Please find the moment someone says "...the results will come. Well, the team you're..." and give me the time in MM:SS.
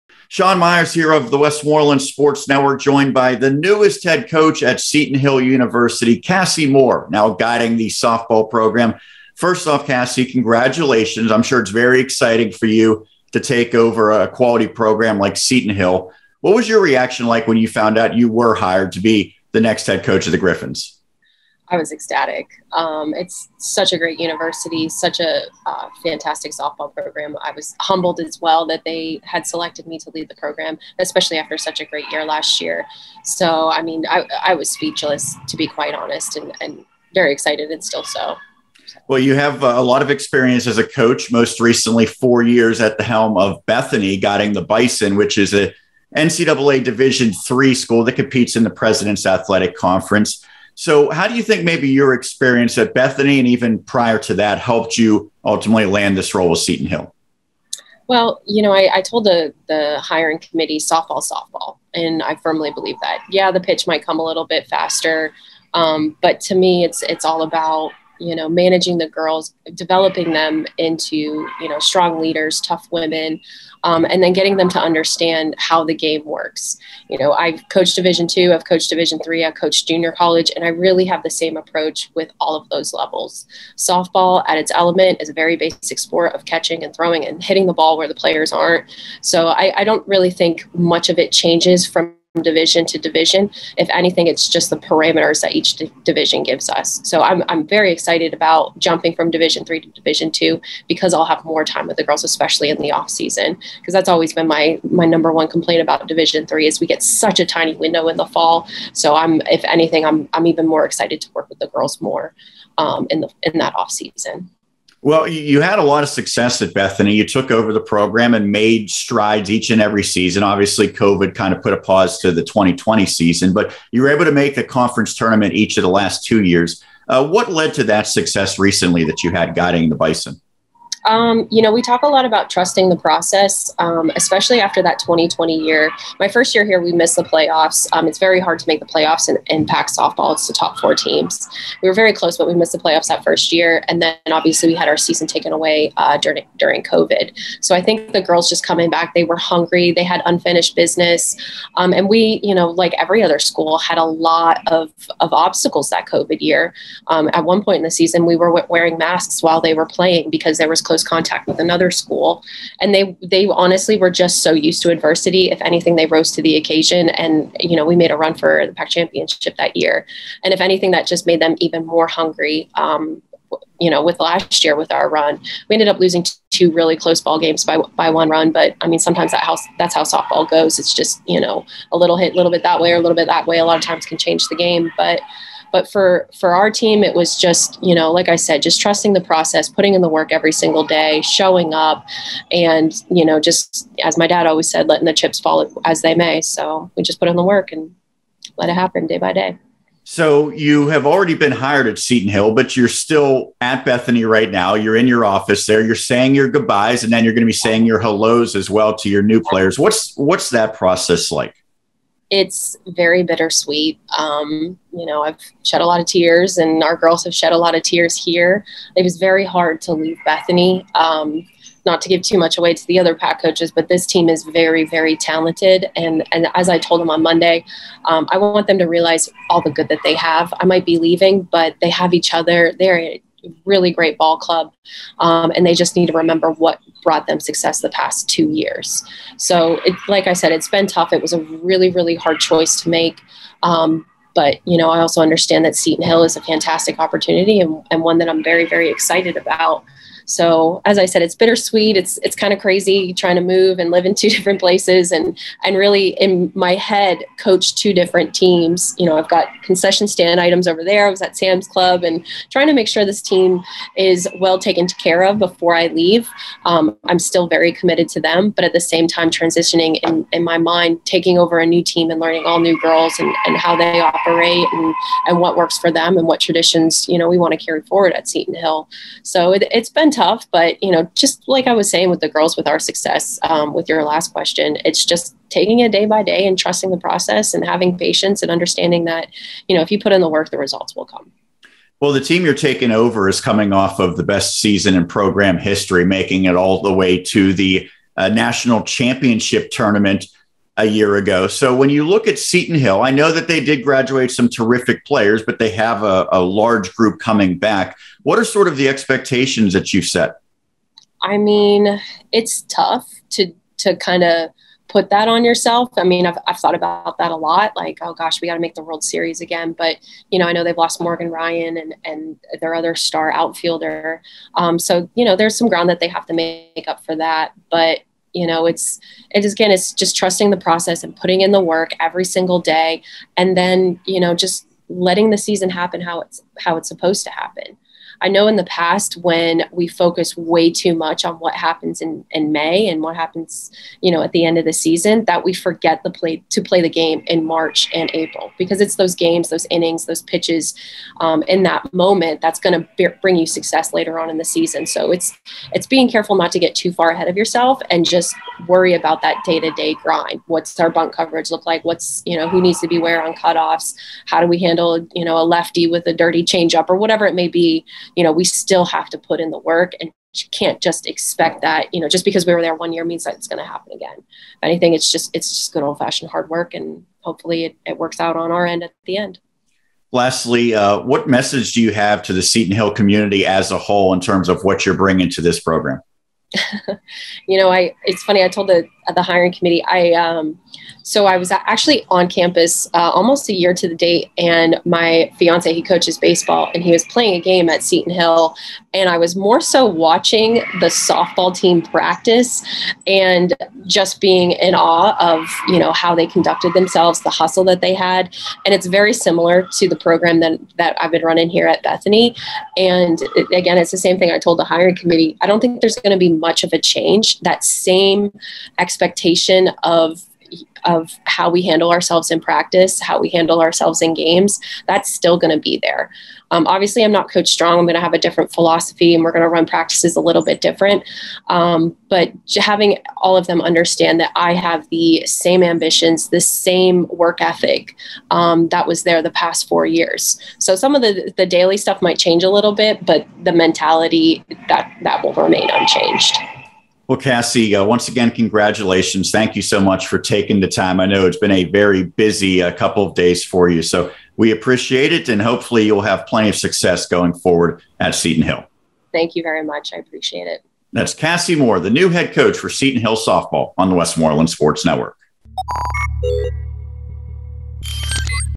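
04:50.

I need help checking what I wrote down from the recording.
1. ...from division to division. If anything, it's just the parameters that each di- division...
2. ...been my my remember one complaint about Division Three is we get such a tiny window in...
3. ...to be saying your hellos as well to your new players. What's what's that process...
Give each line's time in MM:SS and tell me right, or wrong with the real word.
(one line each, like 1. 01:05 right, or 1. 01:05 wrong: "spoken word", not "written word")
1. 01:31 right
2. 01:44 wrong: "number", not "remember"
3. 03:27 right.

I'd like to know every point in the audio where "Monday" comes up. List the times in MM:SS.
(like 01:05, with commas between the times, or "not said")
03:47.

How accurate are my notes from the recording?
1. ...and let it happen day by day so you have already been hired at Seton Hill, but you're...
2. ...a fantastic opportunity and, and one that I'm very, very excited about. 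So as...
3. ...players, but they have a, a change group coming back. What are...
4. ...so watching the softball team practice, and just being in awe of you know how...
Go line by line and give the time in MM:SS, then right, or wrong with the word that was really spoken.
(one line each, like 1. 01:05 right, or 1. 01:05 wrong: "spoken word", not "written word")
1. 03:17 right
2. 04:06 right
3. 05:05 wrong: "large", not "change"
4. 06:39 right.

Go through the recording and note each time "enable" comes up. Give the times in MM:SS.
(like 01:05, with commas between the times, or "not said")
not said.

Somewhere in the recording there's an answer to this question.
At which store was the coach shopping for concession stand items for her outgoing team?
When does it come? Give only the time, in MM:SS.
04:21.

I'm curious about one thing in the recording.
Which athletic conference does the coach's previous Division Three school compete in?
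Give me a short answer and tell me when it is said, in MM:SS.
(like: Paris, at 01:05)
President's Athletic Conference, at 00:48.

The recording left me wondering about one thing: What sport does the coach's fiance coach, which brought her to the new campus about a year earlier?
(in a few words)
baseball.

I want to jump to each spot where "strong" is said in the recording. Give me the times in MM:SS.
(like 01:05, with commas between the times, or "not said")
01:11, 07:07.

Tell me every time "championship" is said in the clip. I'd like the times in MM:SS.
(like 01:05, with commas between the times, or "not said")
02:48, 04:58.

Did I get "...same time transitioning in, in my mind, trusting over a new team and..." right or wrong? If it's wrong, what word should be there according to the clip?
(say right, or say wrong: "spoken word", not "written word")
wrong: "taking", not "trusting".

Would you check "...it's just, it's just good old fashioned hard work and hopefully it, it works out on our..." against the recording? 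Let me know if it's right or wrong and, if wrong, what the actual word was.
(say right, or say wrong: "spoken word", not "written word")
right.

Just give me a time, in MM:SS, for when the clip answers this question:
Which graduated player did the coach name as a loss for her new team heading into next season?
05:21.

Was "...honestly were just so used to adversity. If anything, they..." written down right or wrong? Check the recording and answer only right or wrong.
right.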